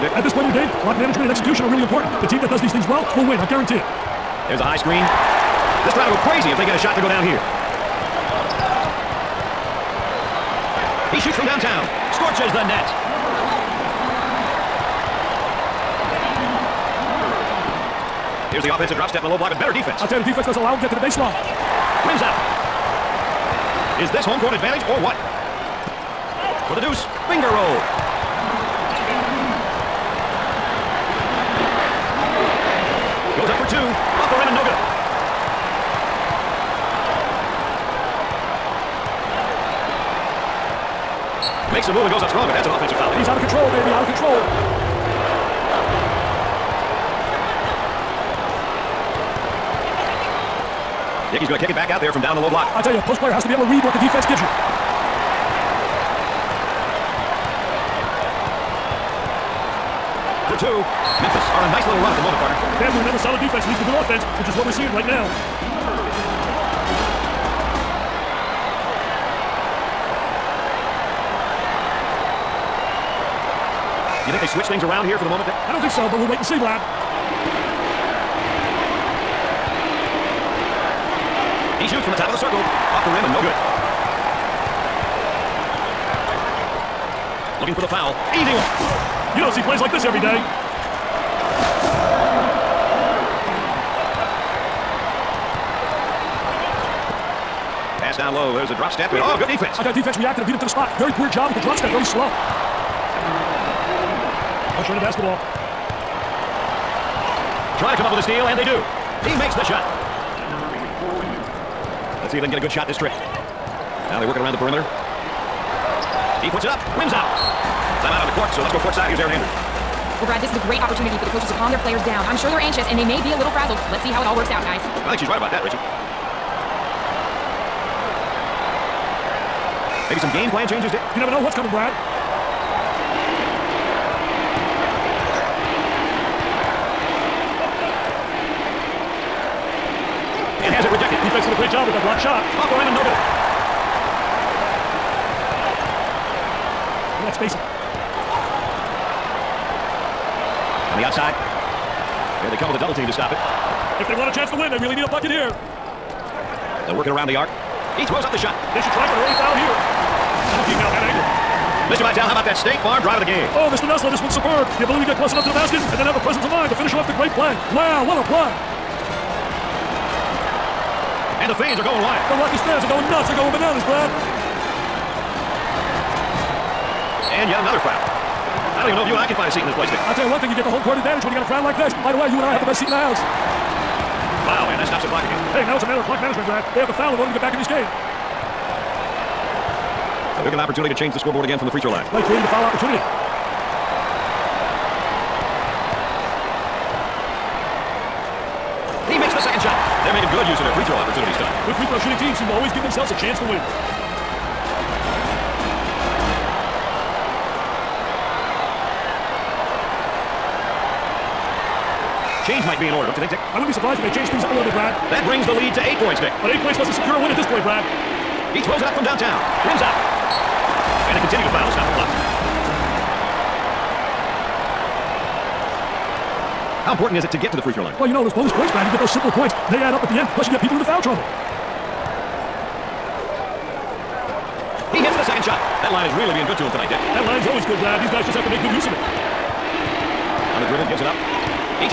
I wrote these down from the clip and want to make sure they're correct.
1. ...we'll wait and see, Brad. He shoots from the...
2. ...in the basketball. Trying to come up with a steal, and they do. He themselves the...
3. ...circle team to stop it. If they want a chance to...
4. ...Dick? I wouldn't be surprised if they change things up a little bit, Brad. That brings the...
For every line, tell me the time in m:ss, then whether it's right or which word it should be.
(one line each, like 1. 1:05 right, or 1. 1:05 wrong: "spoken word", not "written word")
1. 1:16 right
2. 1:44 wrong: "makes", not "themselves"
3. 2:32 wrong: "double", not "circle"
4. 3:33 right.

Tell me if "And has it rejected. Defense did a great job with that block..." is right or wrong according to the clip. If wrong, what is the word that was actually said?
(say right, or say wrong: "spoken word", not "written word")
right.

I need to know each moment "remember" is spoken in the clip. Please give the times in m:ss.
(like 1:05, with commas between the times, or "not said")
1:03.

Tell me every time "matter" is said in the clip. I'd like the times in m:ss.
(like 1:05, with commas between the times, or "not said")
3:05.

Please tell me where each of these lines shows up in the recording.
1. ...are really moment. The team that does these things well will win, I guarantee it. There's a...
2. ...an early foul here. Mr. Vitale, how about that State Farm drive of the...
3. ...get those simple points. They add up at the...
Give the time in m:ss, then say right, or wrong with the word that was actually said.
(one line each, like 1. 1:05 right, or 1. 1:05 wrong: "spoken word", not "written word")
1. 0:01 wrong: "important", not "moment"
2. 2:39 right
3. 3:48 right.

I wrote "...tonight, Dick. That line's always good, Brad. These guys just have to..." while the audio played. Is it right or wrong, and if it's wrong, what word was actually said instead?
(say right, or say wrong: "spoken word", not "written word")
right.